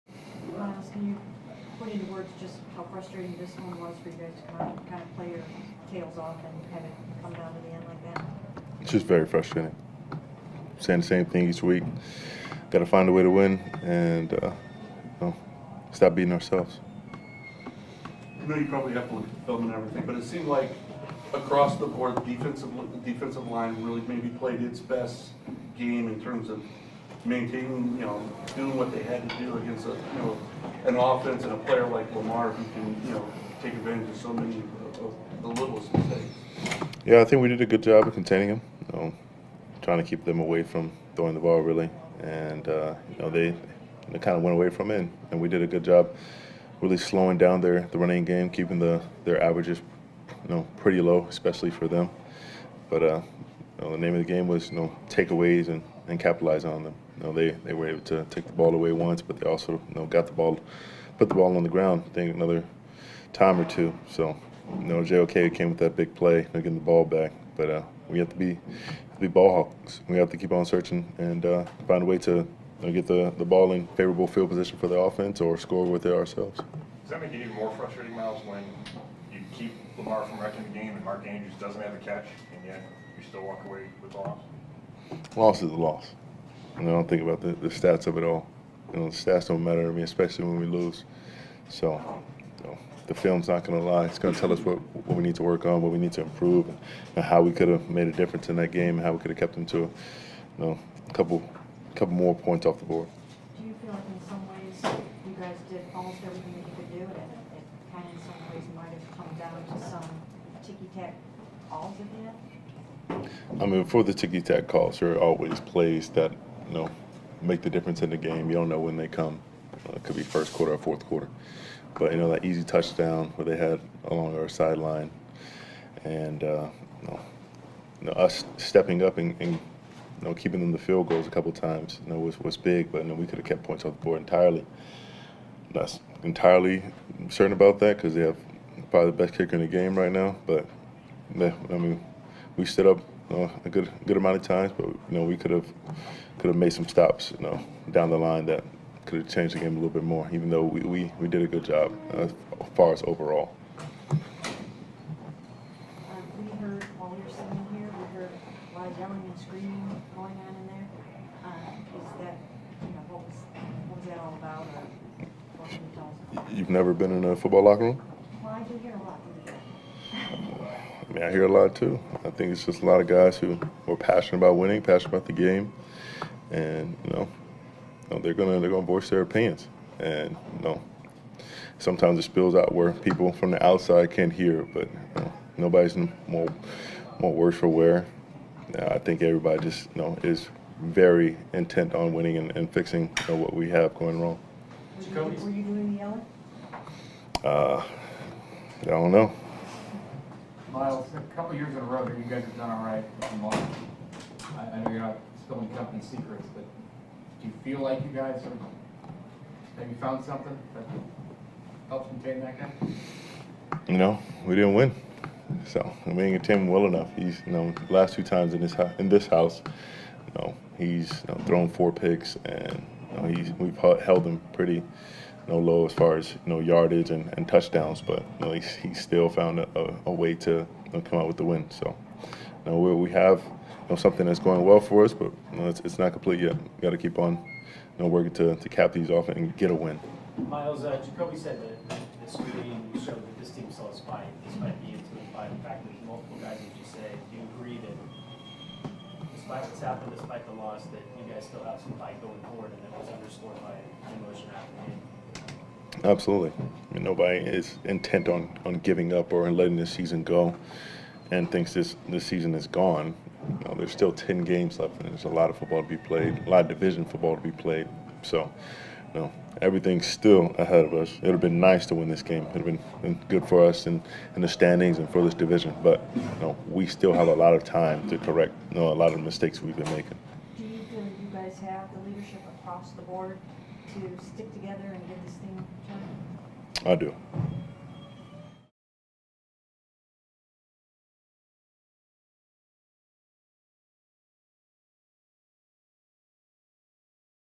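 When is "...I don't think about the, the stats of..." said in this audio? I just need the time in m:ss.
1:26.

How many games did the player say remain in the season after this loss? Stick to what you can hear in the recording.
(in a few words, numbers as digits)
10.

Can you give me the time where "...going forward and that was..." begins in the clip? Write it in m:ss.
4:12.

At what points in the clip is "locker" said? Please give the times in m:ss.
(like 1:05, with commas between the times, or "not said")
2:47.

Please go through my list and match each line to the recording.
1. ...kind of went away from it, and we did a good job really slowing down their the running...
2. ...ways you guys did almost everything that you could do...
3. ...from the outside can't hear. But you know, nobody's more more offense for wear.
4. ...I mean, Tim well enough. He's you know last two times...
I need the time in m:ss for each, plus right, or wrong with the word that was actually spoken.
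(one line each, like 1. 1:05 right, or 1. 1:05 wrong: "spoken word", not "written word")
1. 0:44 right
2. 1:44 right
3. 3:03 wrong: "worse", not "offense"
4. 3:36 right.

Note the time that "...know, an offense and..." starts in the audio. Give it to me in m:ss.
0:30.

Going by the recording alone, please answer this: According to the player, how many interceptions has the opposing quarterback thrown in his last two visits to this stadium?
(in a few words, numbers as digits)
4.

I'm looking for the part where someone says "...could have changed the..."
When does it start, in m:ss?
2:29.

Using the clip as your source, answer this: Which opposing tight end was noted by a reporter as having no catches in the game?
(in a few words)
Mark Andrews.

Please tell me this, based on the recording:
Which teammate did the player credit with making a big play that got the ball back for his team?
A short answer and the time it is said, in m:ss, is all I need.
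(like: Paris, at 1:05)
JOK, at 1:05.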